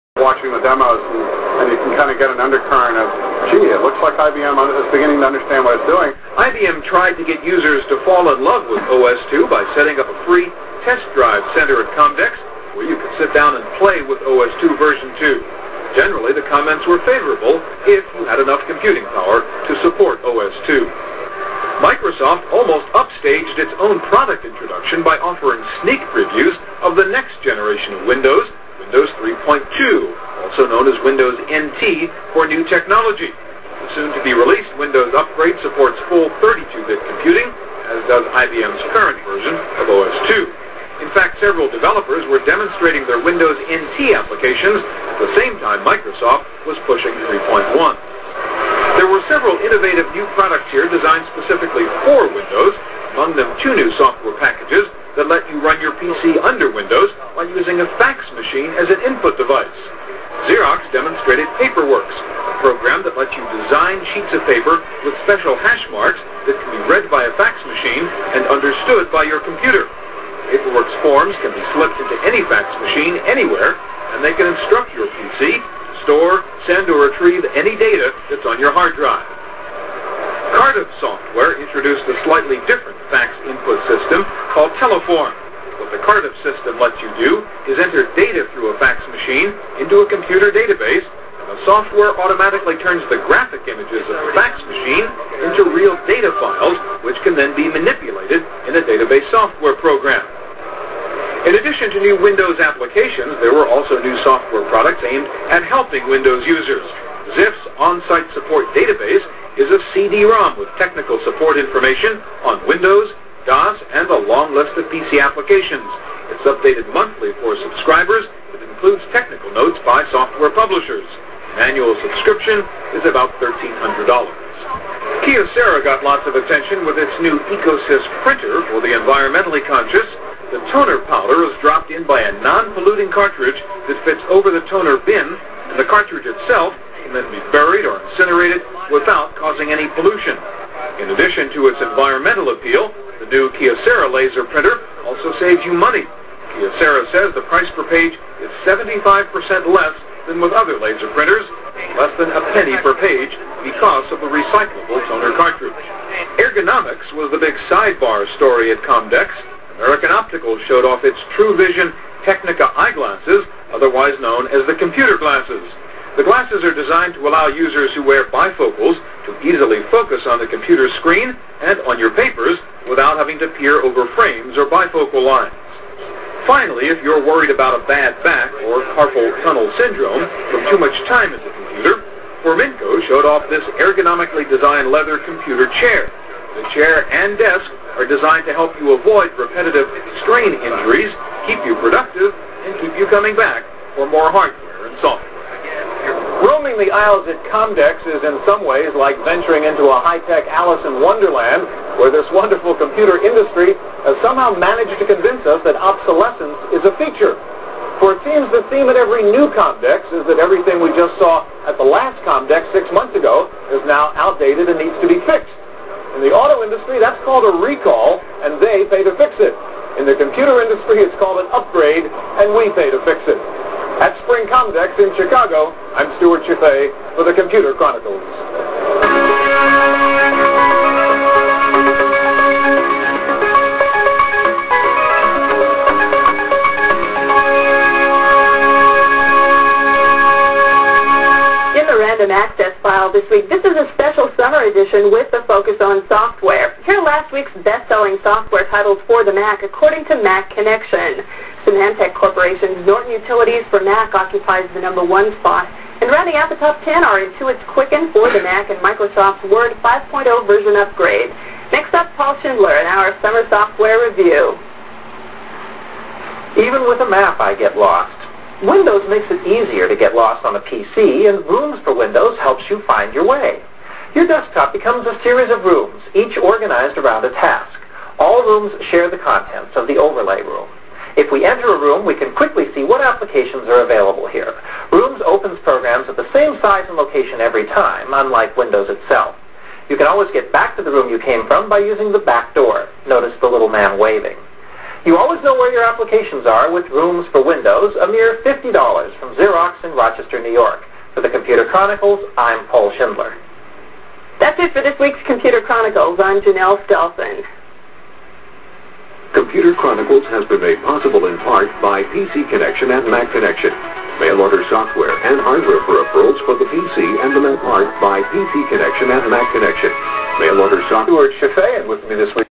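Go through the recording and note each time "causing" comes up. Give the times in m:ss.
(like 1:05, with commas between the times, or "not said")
2:19.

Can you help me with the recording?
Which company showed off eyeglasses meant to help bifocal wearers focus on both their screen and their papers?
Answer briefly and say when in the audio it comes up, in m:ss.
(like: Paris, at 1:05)
American Optical, at 2:39.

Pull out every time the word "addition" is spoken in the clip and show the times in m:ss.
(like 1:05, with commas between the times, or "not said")
1:41, 2:21.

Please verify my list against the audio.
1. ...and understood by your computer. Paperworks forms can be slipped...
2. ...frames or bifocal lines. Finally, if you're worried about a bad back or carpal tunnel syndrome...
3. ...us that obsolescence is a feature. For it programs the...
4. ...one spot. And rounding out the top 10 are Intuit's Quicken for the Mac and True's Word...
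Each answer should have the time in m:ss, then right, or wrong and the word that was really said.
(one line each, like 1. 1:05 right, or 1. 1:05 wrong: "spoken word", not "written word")
1. 1:08 right
2. 2:54 right
3. 3:25 wrong: "seems", not "programs"
4. 4:15 wrong: "Microsoft", not "True".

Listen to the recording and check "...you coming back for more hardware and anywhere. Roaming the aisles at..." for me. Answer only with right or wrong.
wrong.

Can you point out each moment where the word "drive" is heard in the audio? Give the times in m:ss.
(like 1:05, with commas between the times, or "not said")
0:11, 1:18.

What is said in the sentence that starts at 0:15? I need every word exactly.
Generally, the comments were favorable if you had enough computing power to support OS2.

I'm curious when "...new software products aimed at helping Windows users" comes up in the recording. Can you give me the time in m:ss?
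1:44.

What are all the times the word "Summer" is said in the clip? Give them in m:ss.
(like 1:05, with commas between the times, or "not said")
4:23.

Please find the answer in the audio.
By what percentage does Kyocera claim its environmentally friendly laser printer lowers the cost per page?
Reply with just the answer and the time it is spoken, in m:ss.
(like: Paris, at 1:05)
75%, at 2:28.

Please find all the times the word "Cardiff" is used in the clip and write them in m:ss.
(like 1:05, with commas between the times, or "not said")
1:20, 1:26.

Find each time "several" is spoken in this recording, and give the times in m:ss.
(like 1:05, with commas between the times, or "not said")
0:41, 0:49.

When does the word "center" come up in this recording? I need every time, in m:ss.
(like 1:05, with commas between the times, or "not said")
0:11.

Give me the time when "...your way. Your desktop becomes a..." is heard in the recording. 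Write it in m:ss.
4:33.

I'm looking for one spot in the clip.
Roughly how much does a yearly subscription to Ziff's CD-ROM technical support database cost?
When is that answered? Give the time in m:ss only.
2:03.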